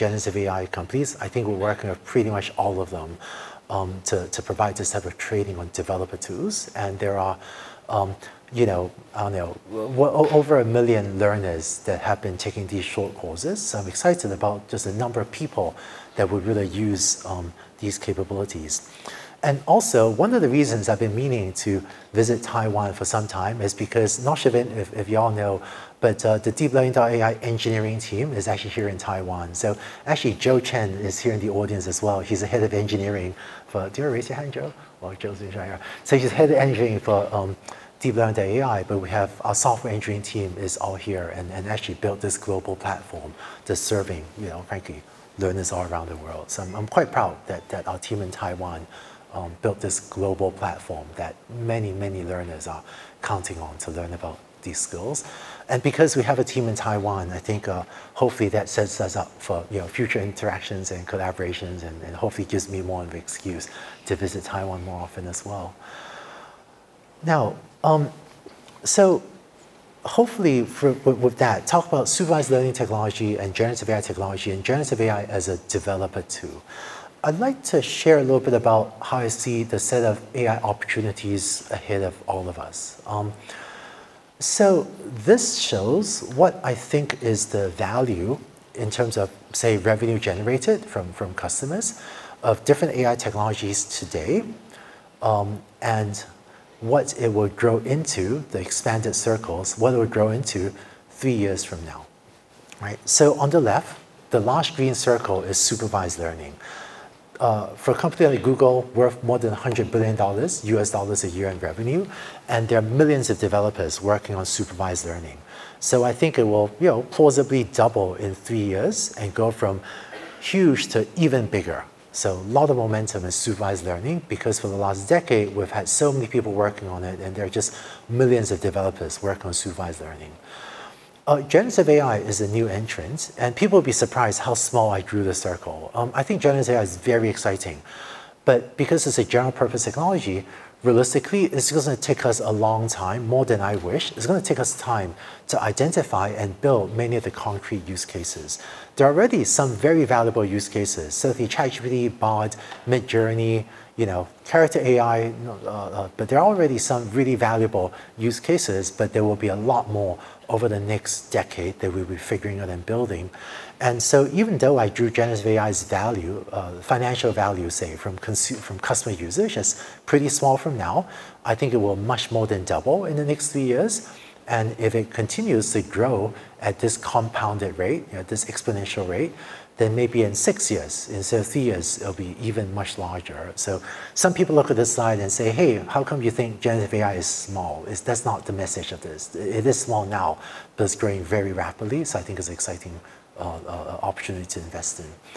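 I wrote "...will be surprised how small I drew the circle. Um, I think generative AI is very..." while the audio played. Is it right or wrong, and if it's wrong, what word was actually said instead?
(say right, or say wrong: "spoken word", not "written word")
right.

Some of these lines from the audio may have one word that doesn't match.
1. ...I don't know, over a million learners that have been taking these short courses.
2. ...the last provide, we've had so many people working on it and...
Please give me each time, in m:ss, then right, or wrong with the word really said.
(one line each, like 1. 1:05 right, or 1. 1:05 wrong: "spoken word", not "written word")
1. 0:09 right
2. 2:04 wrong: "decade", not "provide".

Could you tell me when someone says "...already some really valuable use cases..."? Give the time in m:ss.
2:36.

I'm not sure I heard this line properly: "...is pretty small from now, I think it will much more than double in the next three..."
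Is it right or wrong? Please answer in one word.
right.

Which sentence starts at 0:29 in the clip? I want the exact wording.
So actually, Joe Chen is here in the audience as well.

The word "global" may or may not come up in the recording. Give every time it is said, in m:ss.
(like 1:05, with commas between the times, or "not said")
0:42, 0:50.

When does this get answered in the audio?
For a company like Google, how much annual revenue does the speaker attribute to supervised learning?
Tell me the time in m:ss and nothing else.
1:49.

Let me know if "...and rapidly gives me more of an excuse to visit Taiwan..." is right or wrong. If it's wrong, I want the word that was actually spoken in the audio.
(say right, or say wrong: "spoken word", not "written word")
wrong: "hopefully", not "rapidly".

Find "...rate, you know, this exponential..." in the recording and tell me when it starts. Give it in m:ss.
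2:57.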